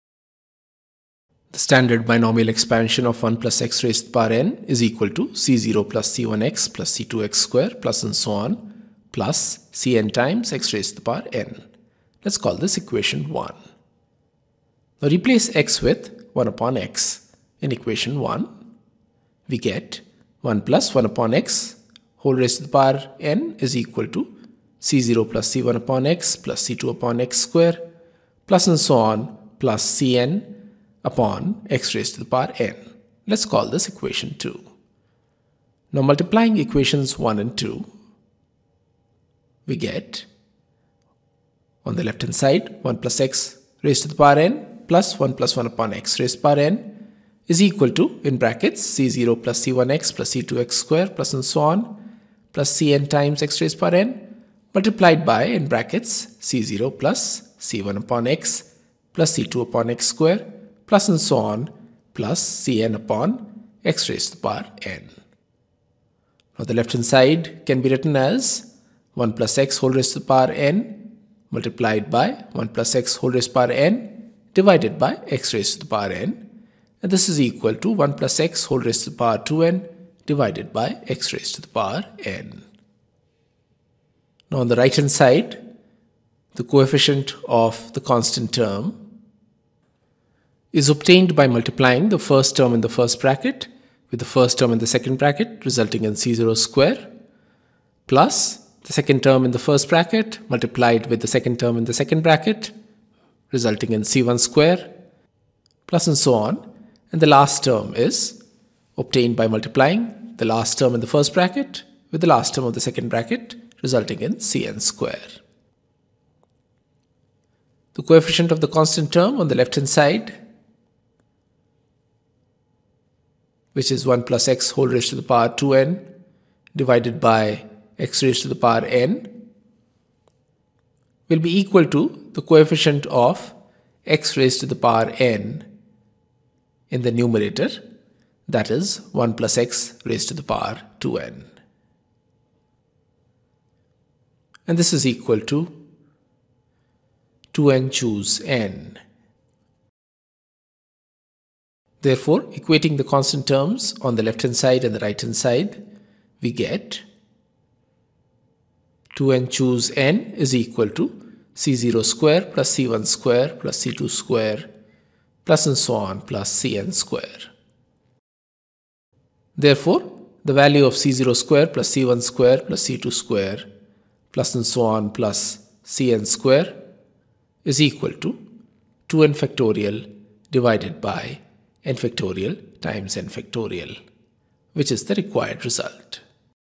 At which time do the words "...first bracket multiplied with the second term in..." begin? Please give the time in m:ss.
1:39.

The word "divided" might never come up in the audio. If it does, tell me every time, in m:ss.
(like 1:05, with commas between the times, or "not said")
1:14, 1:20, 2:06, 3:00.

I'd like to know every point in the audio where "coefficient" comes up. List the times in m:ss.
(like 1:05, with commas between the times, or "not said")
1:26, 1:58, 2:12.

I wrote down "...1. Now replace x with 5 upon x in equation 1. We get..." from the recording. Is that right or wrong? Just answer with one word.
wrong.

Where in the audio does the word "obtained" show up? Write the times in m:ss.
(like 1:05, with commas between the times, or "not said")
1:30, 1:48.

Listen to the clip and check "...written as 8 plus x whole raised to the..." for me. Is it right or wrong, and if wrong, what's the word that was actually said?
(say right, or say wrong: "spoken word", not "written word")
wrong: "1", not "8".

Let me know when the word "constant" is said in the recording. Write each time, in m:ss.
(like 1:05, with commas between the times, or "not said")
1:28, 1:58, 2:33.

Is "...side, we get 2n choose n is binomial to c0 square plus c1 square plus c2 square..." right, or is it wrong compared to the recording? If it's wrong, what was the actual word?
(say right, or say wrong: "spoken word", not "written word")
wrong: "equal", not "binomial".